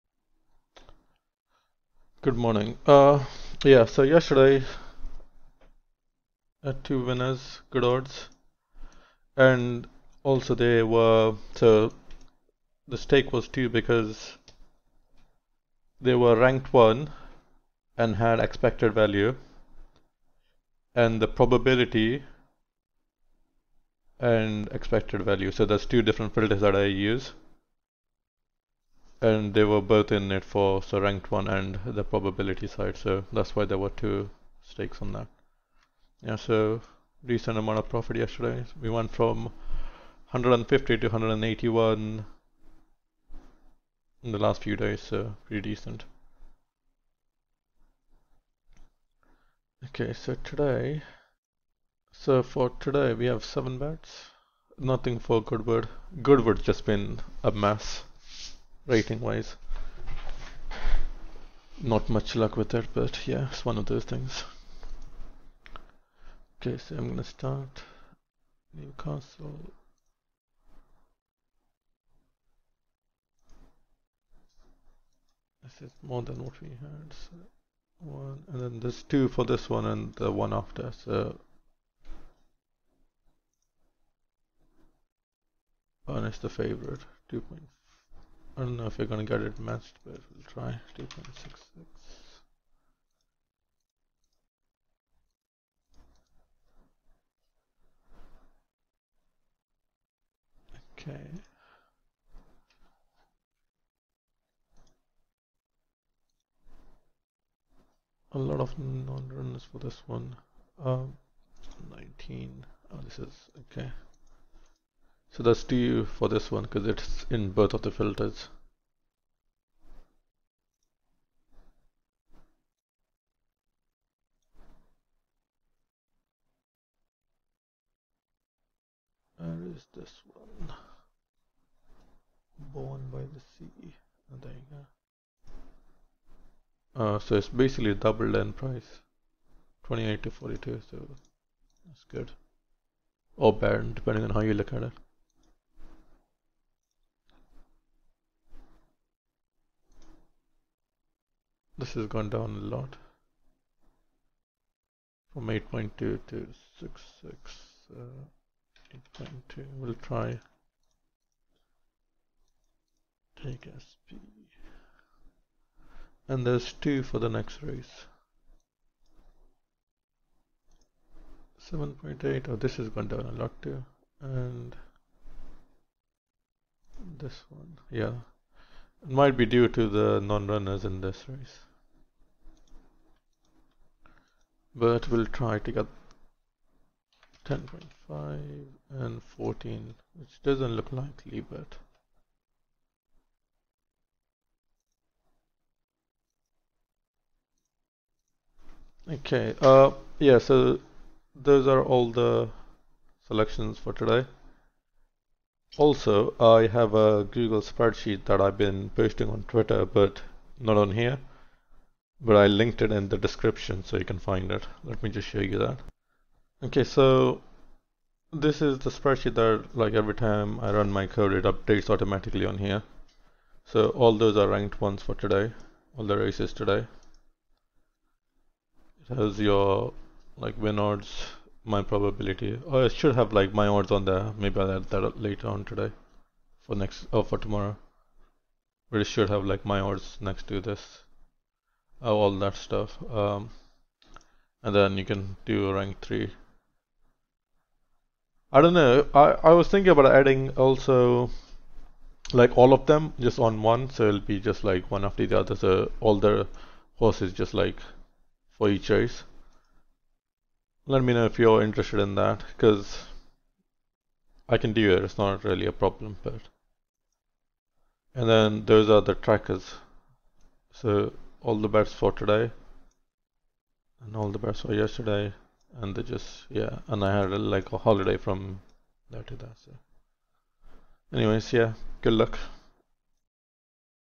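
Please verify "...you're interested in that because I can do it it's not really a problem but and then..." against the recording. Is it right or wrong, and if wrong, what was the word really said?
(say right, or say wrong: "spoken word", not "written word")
right.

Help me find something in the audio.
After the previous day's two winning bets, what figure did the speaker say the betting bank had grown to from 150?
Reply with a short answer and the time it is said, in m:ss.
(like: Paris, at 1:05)
181, at 0:41.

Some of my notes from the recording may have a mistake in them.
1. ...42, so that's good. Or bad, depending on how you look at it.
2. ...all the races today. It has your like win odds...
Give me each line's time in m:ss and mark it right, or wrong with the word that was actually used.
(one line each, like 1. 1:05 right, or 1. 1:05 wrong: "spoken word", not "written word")
1. 2:20 right
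2. 3:45 right.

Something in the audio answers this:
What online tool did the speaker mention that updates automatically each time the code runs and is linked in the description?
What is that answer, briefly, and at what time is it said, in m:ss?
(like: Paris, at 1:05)
Google spreadsheet, at 3:27.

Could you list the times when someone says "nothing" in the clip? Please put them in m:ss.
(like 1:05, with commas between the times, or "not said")
0:54.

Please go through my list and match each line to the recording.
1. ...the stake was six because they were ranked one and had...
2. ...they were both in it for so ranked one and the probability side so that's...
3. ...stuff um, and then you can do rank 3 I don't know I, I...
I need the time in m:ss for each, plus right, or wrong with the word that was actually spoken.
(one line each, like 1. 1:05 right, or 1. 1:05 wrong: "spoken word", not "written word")
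1. 0:12 wrong: "two", not "six"
2. 0:29 right
3. 4:02 right.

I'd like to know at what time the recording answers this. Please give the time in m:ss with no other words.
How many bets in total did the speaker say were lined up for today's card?
0:53.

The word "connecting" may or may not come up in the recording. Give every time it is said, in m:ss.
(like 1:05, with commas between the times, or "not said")
not said.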